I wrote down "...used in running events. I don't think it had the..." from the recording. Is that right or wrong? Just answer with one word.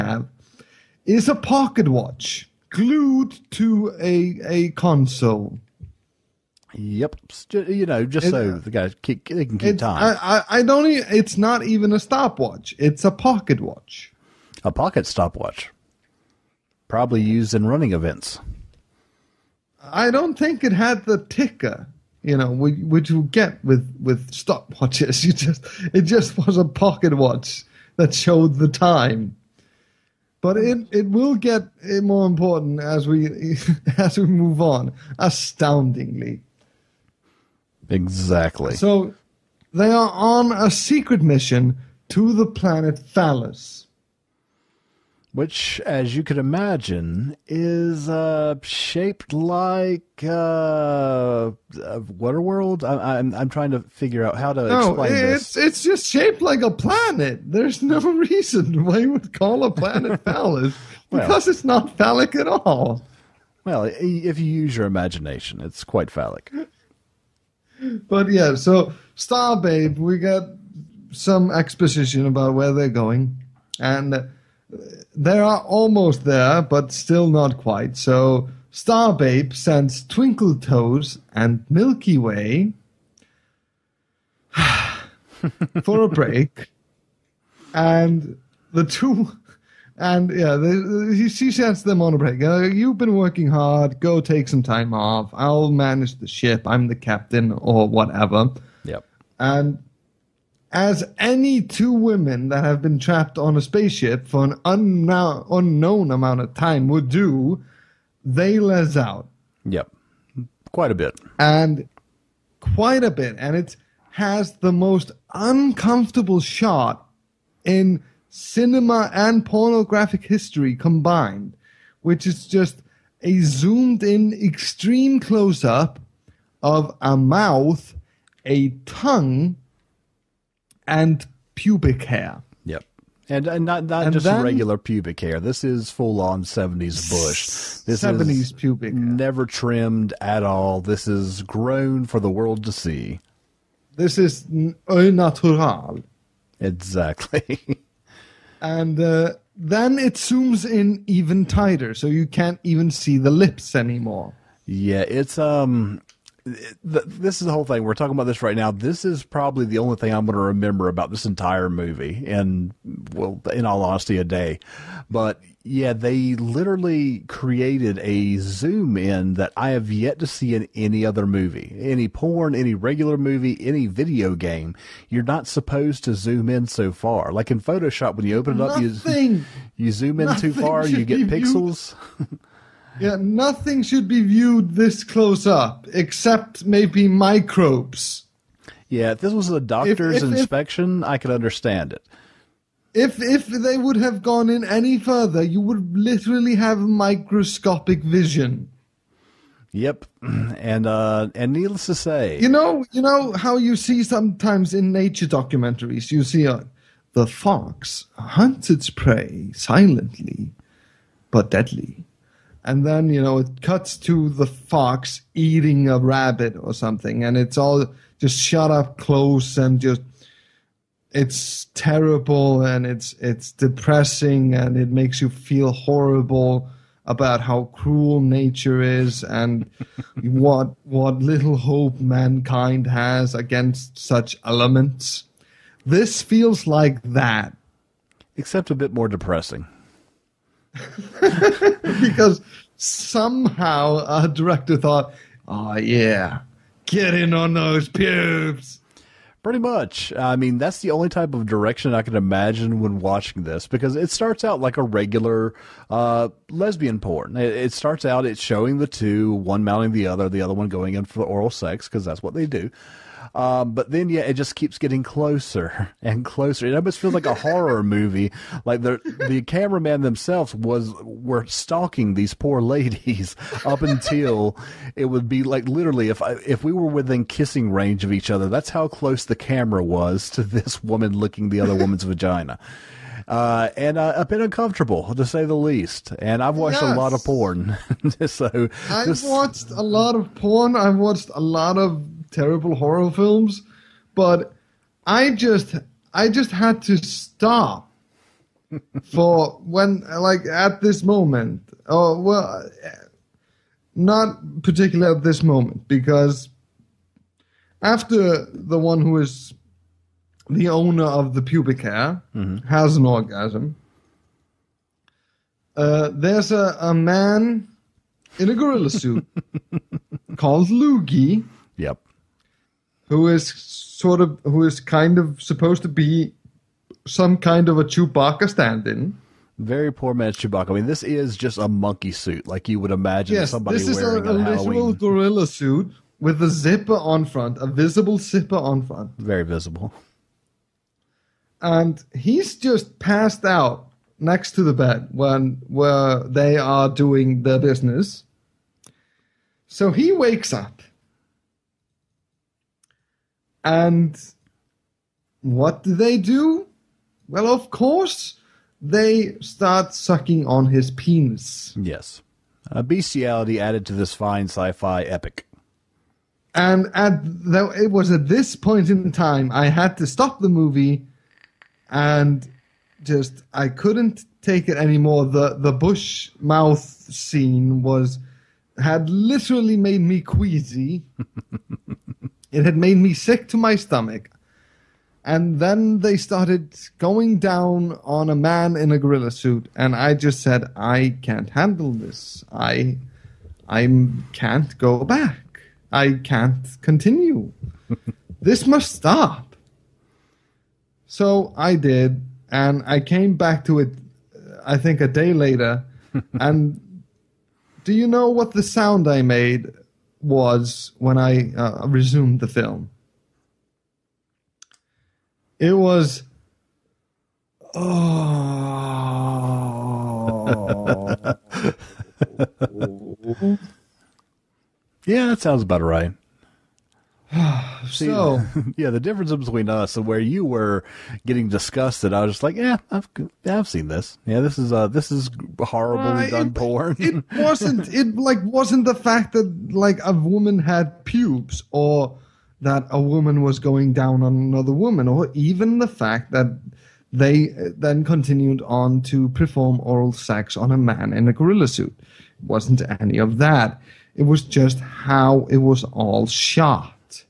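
right.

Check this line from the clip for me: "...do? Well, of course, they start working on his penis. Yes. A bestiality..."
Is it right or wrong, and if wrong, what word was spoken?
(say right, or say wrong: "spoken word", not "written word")
wrong: "sucking", not "working".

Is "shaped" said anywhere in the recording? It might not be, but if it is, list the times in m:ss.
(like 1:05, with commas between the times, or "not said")
0:48, 0:56.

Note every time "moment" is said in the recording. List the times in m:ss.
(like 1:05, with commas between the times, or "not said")
5:01, 5:05.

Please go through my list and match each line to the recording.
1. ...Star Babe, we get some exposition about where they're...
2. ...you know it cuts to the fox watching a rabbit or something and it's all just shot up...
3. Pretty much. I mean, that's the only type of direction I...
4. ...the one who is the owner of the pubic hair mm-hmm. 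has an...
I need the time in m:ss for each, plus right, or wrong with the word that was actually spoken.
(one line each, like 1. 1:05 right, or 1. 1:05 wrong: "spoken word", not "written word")
1. 1:09 right
2. 3:33 wrong: "eating", not "watching"
3. 4:09 right
4. 5:08 right.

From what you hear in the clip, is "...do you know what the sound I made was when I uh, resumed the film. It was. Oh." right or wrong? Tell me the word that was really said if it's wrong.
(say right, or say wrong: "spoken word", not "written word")
right.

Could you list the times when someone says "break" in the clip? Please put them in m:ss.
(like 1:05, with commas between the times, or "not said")
1:26, 1:32.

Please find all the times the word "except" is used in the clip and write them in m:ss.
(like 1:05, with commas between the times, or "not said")
3:05, 3:58.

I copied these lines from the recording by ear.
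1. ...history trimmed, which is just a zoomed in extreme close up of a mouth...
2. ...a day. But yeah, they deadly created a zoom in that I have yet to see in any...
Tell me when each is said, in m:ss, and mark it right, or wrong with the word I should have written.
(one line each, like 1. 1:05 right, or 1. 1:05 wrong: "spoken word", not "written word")
1. 2:00 wrong: "combined", not "trimmed"
2. 2:44 wrong: "literally", not "deadly".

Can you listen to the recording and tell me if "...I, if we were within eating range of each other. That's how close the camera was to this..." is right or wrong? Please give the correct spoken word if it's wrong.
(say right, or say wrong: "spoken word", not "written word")
wrong: "kissing", not "eating".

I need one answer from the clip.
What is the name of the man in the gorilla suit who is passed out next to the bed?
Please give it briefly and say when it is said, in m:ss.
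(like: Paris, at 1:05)
Luigi, at 5:20.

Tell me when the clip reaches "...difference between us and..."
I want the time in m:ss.
7:09.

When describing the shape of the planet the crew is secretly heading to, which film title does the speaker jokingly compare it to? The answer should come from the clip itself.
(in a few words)
Waterworld.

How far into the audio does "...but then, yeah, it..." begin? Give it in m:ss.
4:23.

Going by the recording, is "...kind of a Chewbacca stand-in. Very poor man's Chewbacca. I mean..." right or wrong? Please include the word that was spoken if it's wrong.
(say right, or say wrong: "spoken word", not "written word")
right.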